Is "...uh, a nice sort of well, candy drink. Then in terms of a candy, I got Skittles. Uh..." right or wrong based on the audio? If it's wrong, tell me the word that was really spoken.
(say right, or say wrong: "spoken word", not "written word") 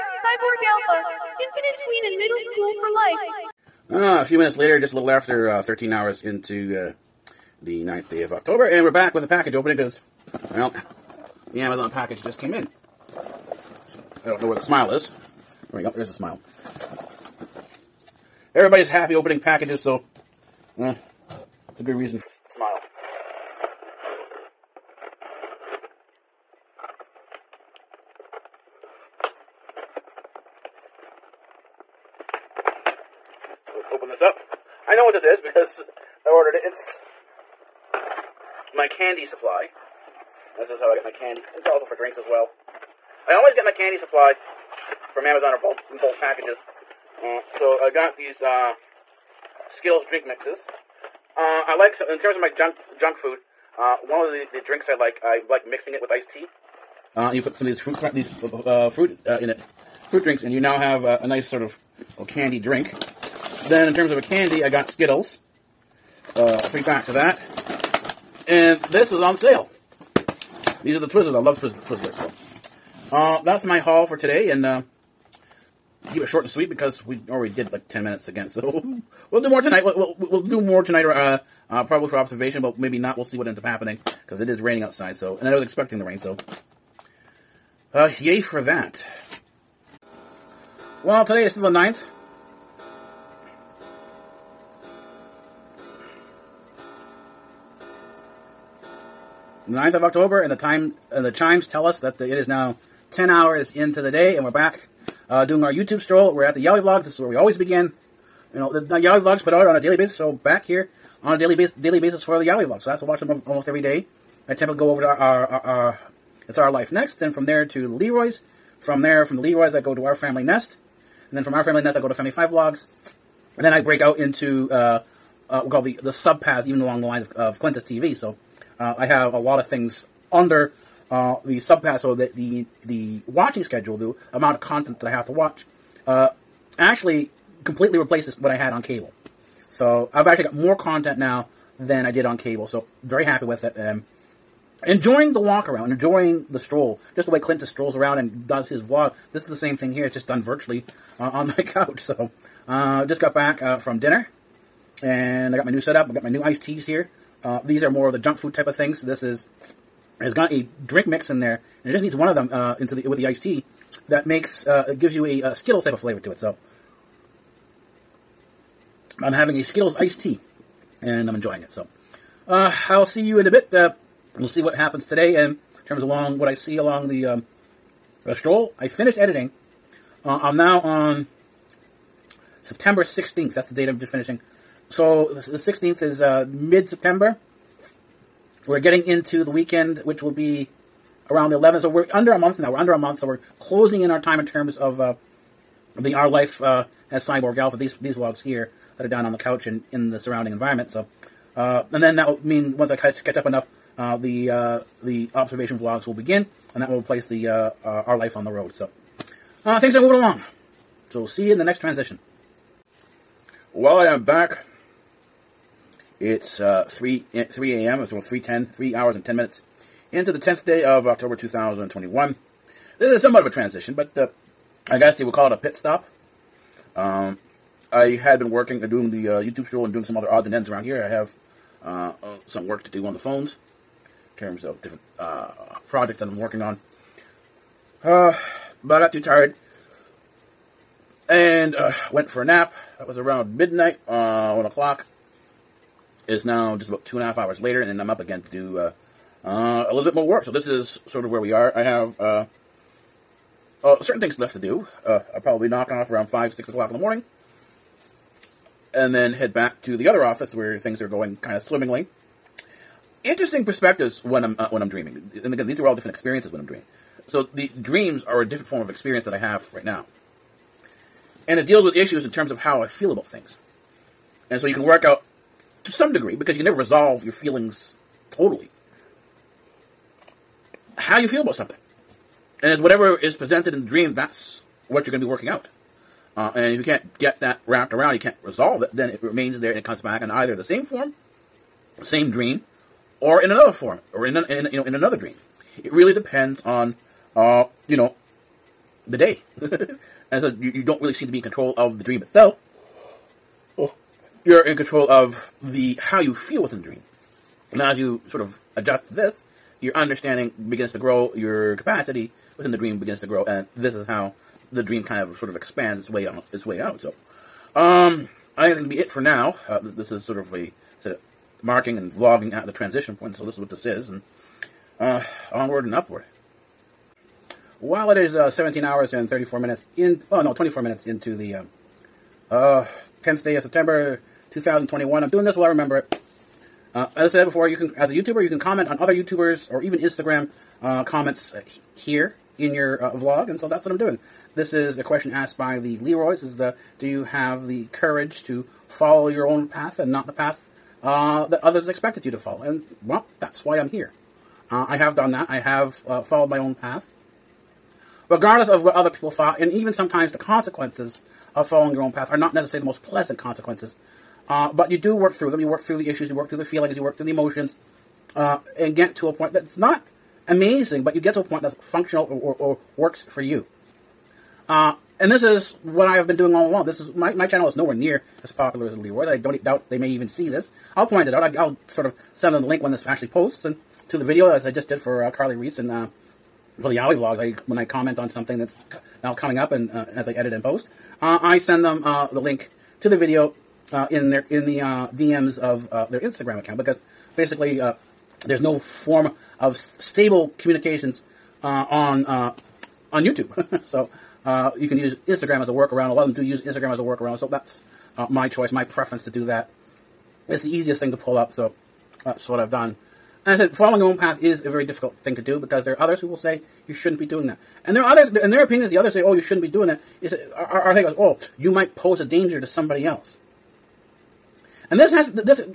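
right.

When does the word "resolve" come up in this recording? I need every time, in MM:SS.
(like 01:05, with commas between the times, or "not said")
04:36, 04:48.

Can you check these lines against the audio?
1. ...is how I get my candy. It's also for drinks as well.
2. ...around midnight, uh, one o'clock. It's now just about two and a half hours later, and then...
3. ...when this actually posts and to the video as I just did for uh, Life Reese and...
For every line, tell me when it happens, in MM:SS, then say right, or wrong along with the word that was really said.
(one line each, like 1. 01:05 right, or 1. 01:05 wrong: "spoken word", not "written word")
1. 00:40 right
2. 04:03 right
3. 06:22 wrong: "Carly", not "Life".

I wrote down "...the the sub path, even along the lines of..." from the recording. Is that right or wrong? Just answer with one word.
right.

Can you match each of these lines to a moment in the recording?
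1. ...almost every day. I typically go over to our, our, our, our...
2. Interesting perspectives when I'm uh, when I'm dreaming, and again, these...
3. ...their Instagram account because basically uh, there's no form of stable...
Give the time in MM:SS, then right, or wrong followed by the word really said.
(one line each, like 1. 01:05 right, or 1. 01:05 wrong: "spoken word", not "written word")
1. 01:53 right
2. 04:23 right
3. 06:36 right.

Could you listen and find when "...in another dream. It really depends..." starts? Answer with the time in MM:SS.
04:54.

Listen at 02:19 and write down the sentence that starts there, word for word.
So I've actually got more content now than I did on cable.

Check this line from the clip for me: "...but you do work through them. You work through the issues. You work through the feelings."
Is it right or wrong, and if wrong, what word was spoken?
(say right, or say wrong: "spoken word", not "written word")
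right.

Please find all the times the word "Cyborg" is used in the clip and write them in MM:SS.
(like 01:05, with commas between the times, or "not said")
00:00, 03:17.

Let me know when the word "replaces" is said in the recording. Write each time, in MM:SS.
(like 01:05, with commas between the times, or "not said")
02:17, 03:26.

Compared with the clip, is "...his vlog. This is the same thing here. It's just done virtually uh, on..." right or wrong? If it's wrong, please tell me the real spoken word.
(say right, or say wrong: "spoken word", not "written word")
right.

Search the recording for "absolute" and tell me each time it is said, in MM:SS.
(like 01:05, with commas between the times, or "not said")
not said.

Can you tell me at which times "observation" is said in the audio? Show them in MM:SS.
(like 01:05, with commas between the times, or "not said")
01:22, 03:25.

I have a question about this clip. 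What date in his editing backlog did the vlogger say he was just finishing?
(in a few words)
September 16th.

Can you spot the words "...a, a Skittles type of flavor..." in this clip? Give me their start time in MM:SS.
02:45.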